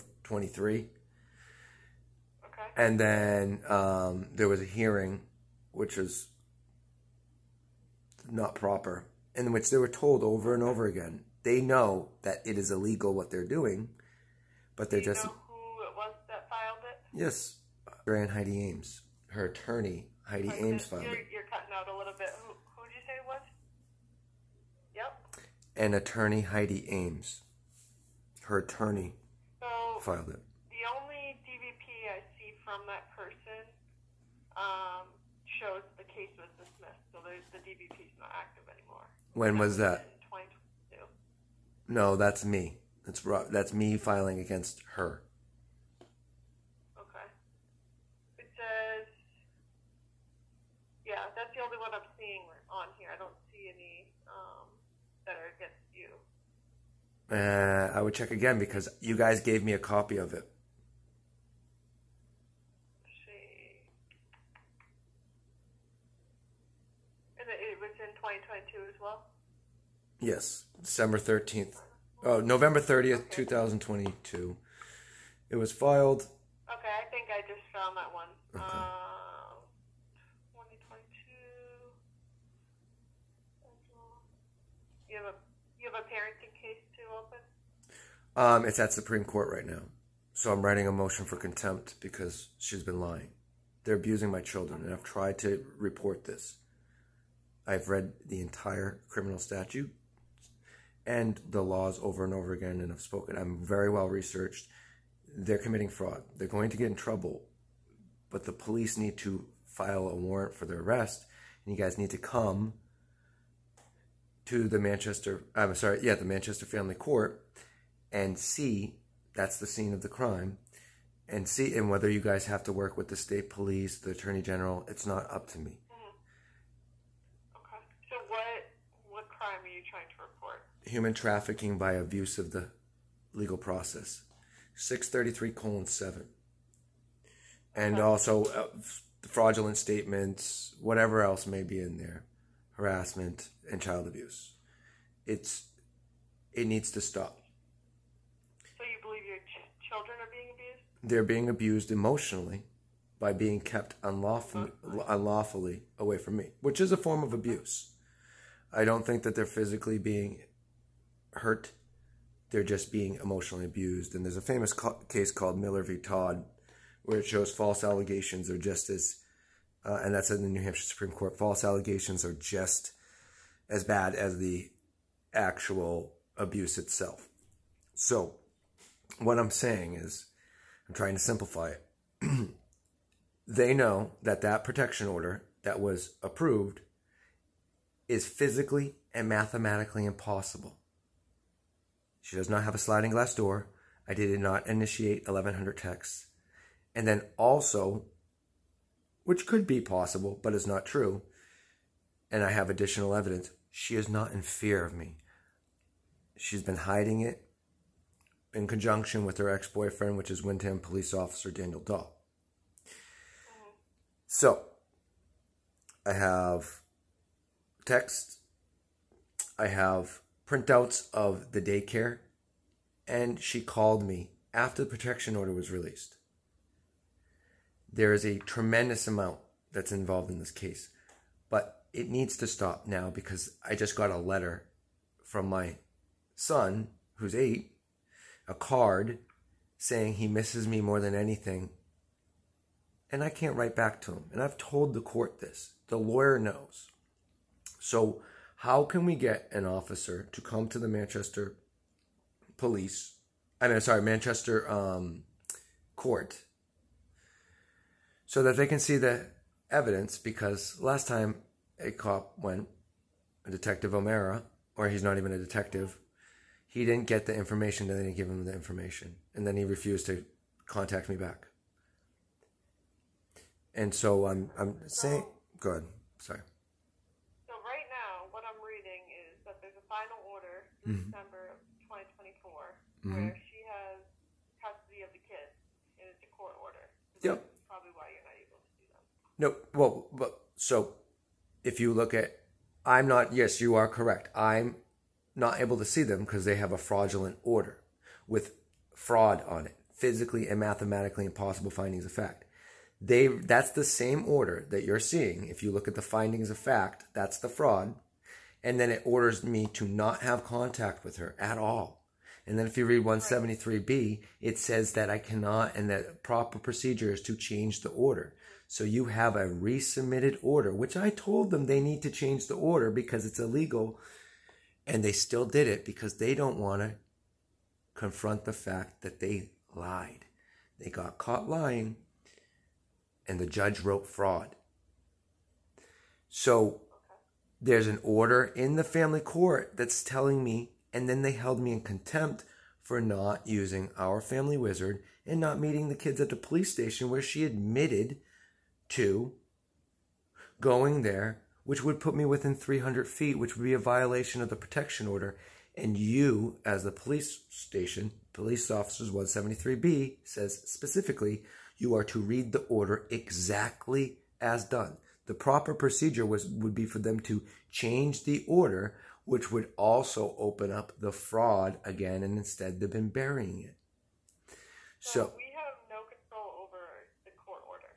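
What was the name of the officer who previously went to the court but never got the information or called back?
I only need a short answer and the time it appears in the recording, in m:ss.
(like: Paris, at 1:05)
O'Mara, at 4:23.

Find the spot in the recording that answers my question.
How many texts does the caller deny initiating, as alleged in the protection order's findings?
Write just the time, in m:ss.
3:15.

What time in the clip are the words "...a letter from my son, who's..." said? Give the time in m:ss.
3:54.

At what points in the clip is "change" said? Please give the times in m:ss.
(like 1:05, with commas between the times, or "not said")
5:17, 5:22, 6:07.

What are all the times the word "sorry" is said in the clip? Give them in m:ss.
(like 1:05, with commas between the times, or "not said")
1:55, 4:13, 4:36.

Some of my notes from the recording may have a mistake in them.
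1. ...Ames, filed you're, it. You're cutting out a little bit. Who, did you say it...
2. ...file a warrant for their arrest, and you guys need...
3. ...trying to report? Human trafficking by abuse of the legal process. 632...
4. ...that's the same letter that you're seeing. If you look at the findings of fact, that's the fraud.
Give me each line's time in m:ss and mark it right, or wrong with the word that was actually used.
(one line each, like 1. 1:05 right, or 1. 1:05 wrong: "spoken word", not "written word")
1. 0:20 right
2. 1:49 right
3. 2:09 wrong: "633", not "632"
4. 5:03 wrong: "order", not "letter".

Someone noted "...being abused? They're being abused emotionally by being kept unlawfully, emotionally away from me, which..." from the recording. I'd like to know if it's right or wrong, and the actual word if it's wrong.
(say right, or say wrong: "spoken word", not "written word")
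wrong: "unlawfully", not "emotionally".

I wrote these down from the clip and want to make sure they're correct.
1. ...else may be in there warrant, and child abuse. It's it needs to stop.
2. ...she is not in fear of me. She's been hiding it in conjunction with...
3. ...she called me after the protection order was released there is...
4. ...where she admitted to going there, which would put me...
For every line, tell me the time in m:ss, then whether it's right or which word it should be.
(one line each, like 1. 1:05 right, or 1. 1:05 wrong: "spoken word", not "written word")
1. 2:21 wrong: "harassment", not "warrant"
2. 3:23 right
3. 3:43 right
4. 5:47 right.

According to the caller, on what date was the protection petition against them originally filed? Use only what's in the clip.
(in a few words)
November 30, 2022.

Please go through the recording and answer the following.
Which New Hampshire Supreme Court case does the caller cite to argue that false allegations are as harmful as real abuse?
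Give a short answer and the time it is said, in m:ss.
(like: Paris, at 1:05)
Miller v. Todd, at 2:45.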